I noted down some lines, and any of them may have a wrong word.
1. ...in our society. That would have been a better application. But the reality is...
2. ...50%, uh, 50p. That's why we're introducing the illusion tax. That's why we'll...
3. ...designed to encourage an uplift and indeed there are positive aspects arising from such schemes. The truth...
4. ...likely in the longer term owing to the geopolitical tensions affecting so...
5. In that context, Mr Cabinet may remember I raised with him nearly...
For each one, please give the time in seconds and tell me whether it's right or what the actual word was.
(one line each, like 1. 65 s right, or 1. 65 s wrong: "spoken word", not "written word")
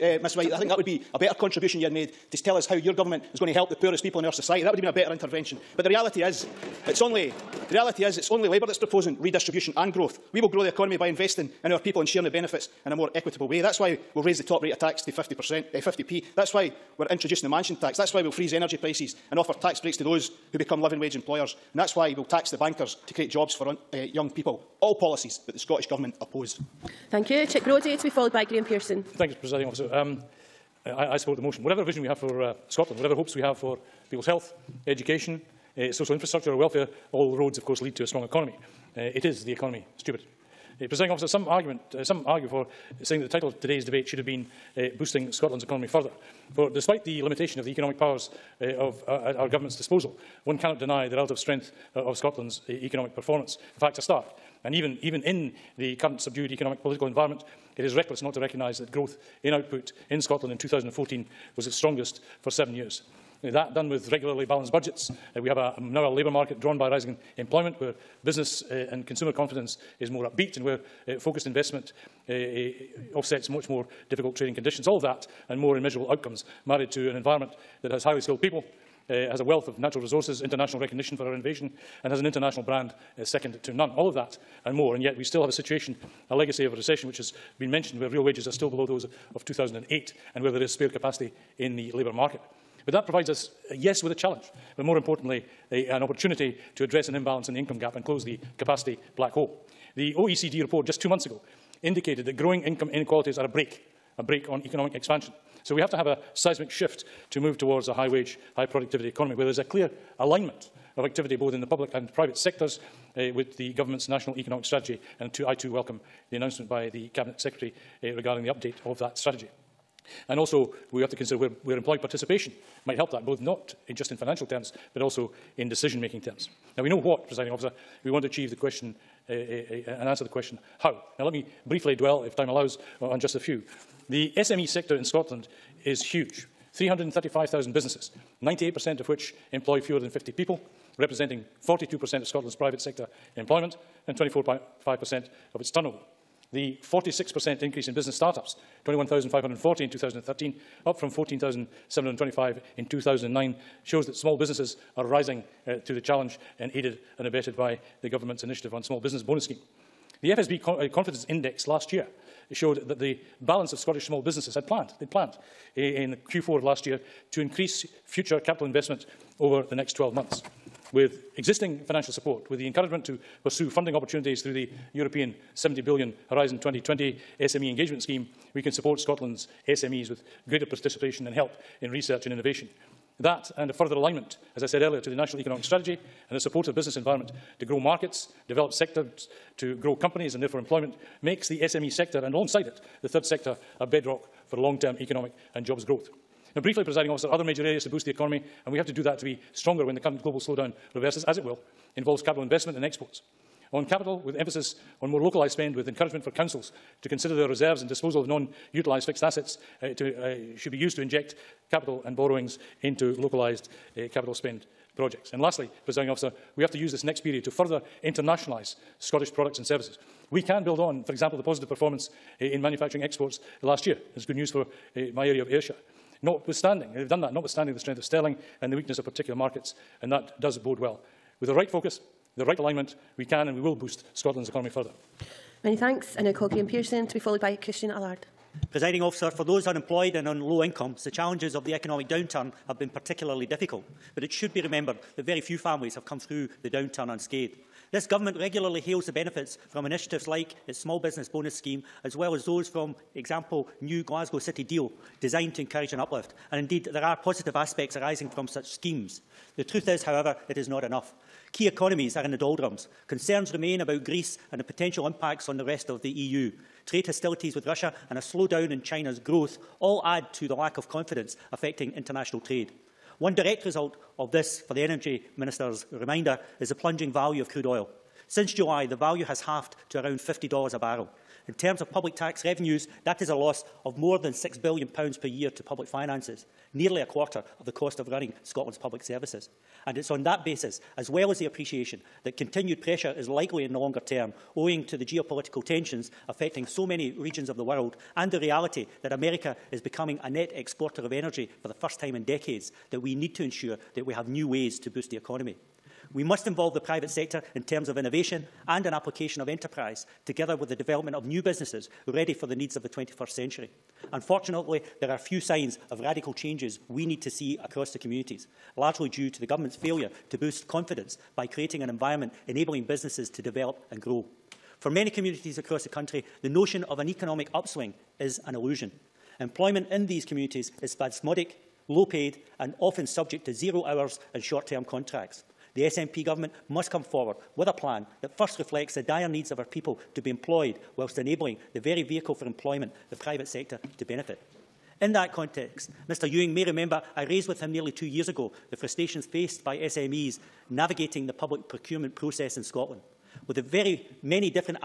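1. 4 s wrong: "intervention", not "application"
2. 15 s wrong: "mansion", not "illusion"
3. 255 s right
4. 293 s right
5. 344 s wrong: "Ewing", not "Cabinet".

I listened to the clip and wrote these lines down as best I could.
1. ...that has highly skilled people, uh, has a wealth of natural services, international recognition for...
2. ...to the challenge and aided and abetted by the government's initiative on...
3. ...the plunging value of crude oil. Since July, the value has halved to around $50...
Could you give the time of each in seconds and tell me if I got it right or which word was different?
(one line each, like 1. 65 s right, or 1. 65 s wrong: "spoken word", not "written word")
1. 77 s wrong: "resources", not "services"
2. 155 s right
3. 276 s right.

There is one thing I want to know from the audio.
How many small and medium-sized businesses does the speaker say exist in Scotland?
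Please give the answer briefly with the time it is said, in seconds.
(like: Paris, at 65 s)
335,000, at 136 s.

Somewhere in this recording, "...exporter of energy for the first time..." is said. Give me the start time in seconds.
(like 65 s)
300 s.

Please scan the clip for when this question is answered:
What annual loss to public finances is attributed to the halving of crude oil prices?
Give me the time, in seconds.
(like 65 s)
283 s.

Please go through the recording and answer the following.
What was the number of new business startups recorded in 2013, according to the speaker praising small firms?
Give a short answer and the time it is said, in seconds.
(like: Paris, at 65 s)
21,540, at 148 s.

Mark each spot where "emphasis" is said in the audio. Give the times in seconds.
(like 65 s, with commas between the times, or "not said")
204 s.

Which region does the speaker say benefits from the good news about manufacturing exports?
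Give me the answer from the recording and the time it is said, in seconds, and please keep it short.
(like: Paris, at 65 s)
Ayrshire, at 225 s.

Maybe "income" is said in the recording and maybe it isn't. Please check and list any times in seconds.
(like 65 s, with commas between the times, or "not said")
97 s, 102 s, 240 s.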